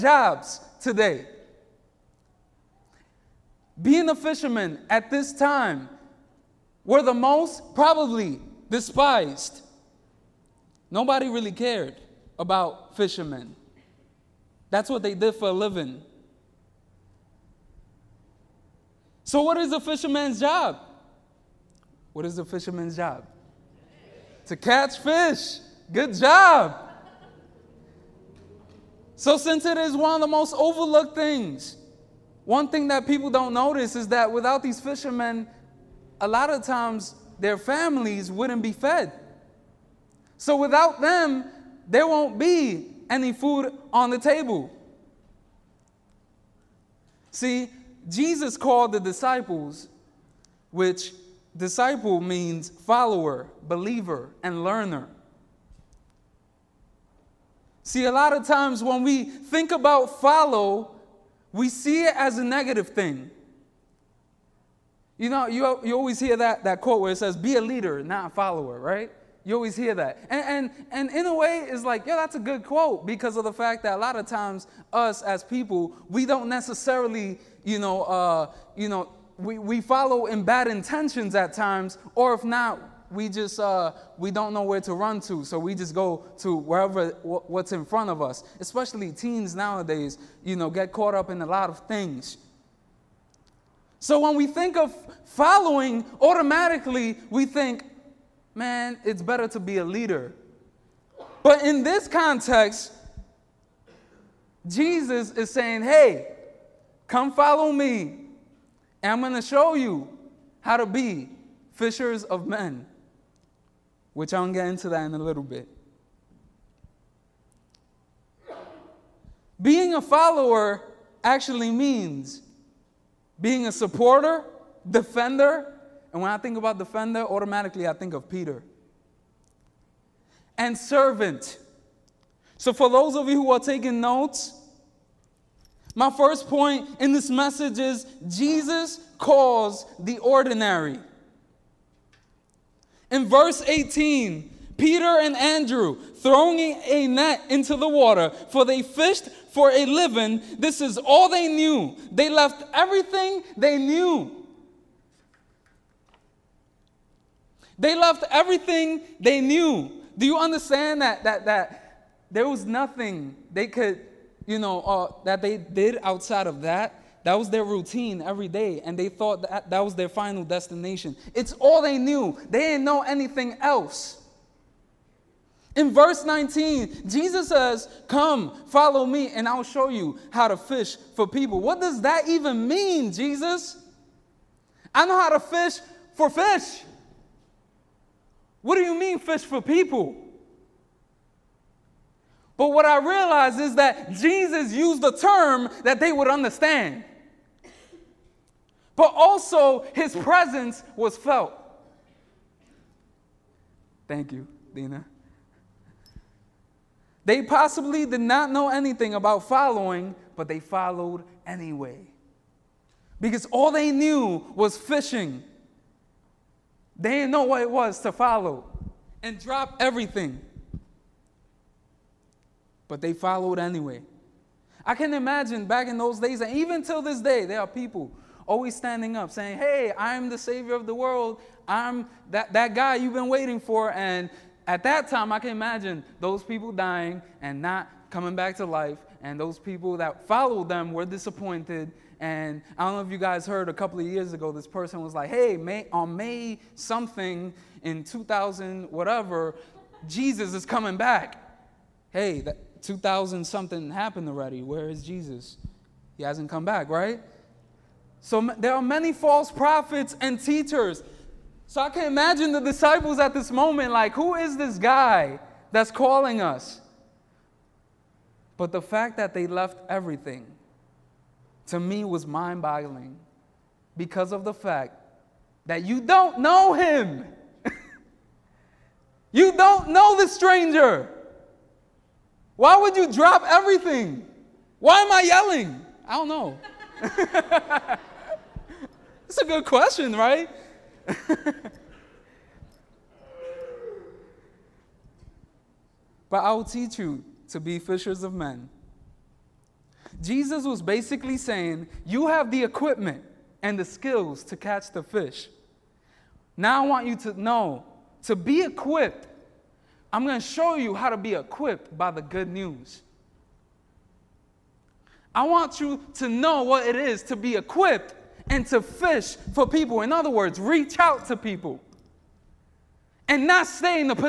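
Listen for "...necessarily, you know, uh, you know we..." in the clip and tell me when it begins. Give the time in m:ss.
1:16.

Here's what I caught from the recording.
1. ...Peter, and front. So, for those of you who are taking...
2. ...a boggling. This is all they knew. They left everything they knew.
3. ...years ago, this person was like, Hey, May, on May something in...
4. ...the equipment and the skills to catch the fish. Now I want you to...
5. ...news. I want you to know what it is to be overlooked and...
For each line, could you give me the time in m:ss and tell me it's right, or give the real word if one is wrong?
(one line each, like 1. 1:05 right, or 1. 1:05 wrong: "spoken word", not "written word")
1. 2:08 wrong: "servant", not "front"
2. 2:29 wrong: "living", not "boggling"
3. 4:04 right
4. 5:02 right
5. 5:12 wrong: "equipped", not "overlooked".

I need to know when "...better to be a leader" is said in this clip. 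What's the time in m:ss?
1:39.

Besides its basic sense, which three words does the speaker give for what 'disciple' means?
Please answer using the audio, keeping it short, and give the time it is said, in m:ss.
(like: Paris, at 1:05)
follower, believer, and learner, at 0:52.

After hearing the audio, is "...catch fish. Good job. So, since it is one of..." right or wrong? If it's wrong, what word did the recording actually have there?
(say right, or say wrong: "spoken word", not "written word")
right.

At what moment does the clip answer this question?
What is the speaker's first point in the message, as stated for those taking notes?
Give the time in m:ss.
2:18.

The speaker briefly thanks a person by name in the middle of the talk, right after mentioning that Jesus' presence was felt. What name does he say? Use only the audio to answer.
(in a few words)
Dina.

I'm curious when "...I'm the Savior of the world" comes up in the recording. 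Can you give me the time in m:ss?
3:49.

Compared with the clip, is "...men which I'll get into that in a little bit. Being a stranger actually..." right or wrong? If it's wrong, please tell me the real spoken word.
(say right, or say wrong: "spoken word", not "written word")
wrong: "follower", not "stranger".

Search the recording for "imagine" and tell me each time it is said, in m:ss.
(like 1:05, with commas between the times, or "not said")
3:45, 3:55, 4:22.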